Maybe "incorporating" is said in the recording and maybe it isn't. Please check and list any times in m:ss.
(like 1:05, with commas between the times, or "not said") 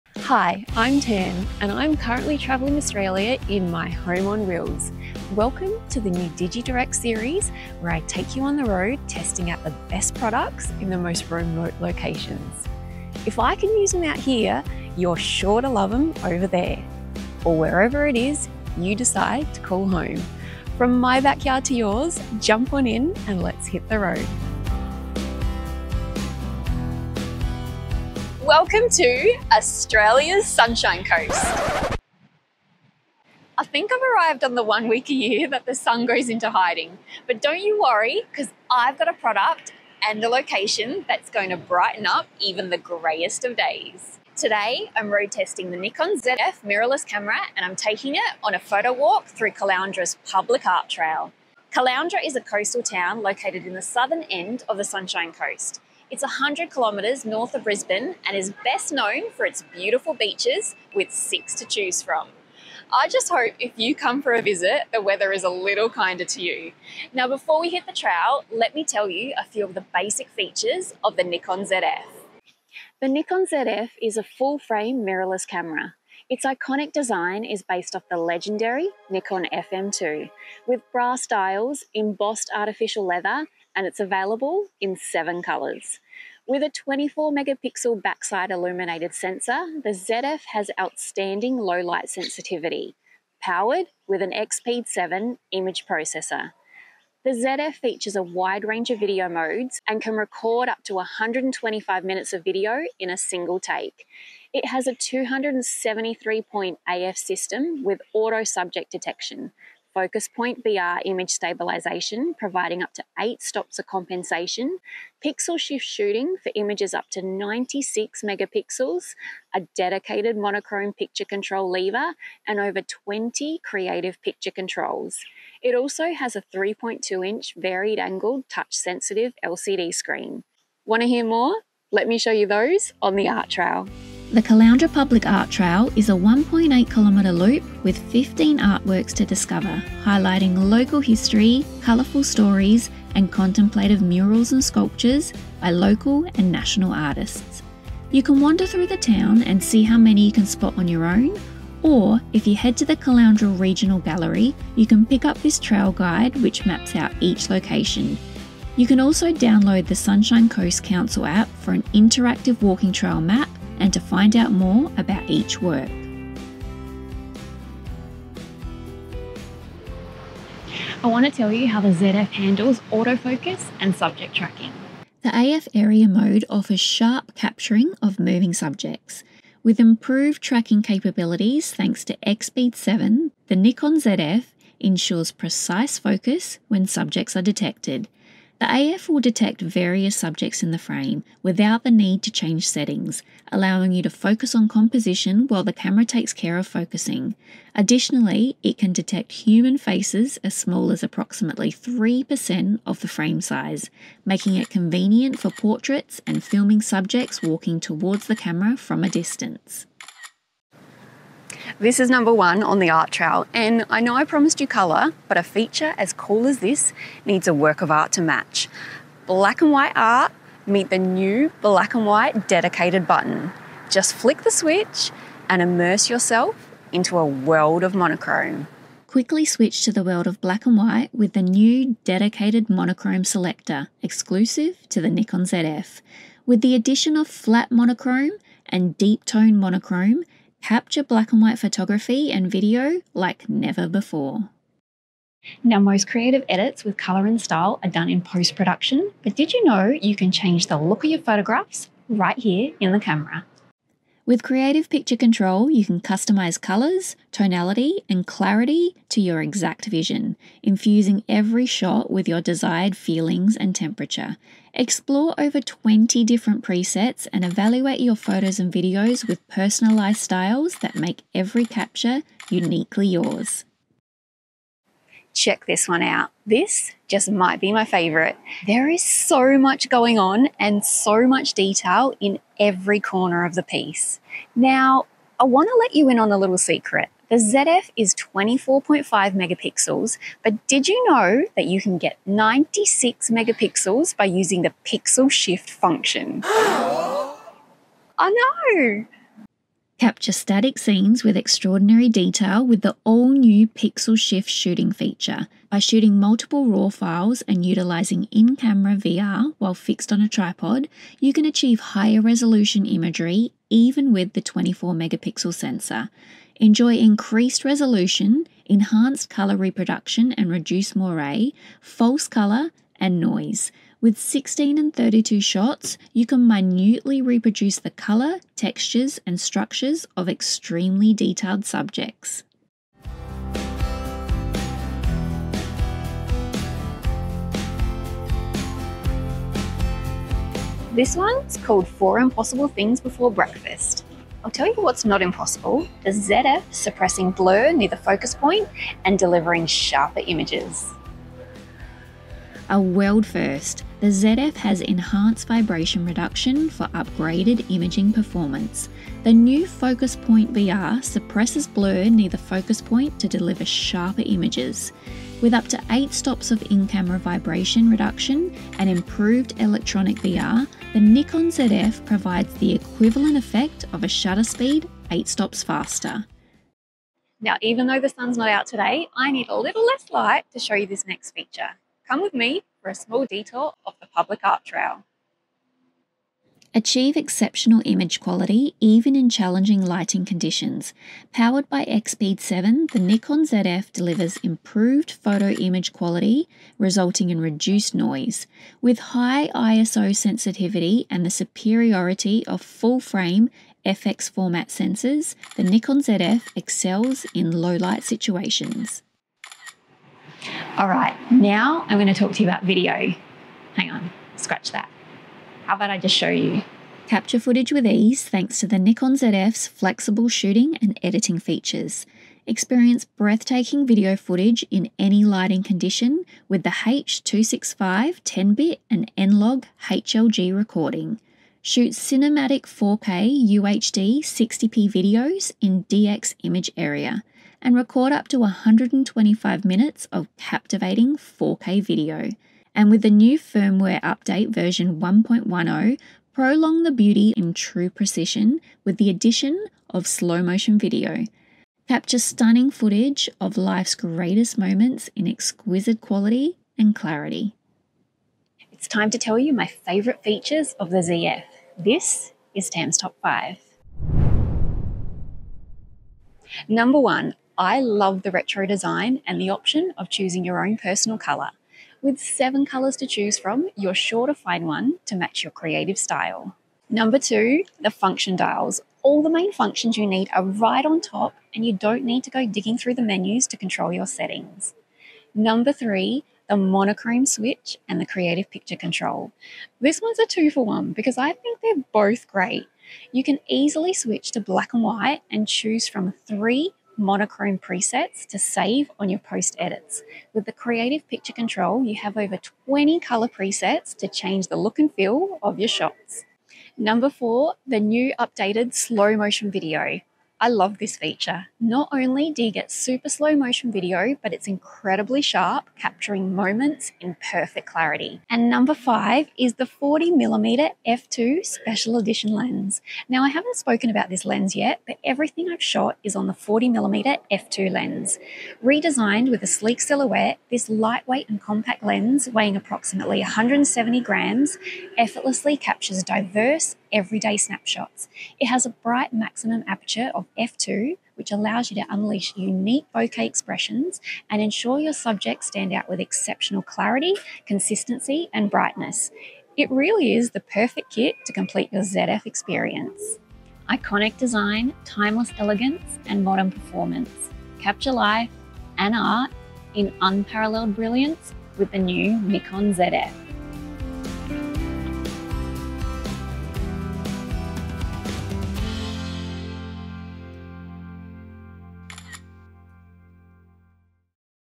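not said.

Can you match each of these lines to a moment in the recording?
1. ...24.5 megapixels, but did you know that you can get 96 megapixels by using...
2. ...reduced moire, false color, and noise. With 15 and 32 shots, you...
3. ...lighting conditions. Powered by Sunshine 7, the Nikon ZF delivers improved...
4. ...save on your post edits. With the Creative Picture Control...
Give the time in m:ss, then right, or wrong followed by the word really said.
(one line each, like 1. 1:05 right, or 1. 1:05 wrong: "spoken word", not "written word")
1. 4:48 right
2. 5:20 wrong: "16", not "15"
3. 6:29 wrong: "EXPEED", not "Sunshine"
4. 8:18 right.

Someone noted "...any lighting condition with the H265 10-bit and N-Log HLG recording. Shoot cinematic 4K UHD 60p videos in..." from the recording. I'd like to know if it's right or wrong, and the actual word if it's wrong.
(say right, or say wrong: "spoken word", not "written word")
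right.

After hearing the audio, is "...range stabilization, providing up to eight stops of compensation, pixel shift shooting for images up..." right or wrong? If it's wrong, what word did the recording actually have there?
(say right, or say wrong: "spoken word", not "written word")
wrong: "image", not "range".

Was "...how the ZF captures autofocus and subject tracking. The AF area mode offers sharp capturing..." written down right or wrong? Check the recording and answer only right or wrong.
wrong.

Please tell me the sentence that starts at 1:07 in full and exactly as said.
Now, before we hit the trail, let me tell you a few of the basic features of the Nikon ZF.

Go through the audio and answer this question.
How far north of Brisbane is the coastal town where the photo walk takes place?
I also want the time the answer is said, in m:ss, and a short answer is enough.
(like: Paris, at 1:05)
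100 kilometres, at 0:56.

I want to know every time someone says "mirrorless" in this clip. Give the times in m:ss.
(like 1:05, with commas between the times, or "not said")
0:46, 1:15.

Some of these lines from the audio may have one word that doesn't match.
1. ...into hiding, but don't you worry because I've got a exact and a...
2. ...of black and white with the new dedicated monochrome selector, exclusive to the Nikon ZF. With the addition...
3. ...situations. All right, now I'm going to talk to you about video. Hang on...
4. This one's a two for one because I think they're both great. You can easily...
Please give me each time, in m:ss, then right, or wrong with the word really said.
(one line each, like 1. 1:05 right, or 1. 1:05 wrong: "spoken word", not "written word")
1. 0:36 wrong: "product", not "exact"
2. 3:50 right
3. 6:48 right
4. 8:09 right.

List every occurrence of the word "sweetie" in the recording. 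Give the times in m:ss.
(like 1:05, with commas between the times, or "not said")
not said.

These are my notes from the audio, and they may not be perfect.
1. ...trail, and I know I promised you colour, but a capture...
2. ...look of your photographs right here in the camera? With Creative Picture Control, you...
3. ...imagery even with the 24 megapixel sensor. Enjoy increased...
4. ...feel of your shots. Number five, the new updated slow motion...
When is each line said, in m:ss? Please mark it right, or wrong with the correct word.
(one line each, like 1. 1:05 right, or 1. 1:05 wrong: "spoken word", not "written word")
1. 3:33 wrong: "feature", not "capture"
2. 4:10 right
3. 5:12 right
4. 8:24 wrong: "four", not "five".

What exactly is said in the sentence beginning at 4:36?
This just might be my favorite.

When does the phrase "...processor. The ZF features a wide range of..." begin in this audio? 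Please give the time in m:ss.
1:35.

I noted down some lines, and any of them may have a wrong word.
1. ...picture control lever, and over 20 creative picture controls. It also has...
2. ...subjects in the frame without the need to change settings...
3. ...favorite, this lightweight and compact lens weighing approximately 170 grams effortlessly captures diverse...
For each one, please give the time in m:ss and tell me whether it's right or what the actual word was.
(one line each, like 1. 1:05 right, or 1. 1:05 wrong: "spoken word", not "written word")
1. 2:00 right
2. 3:10 right
3. 8:49 wrong: "silhouette", not "favorite".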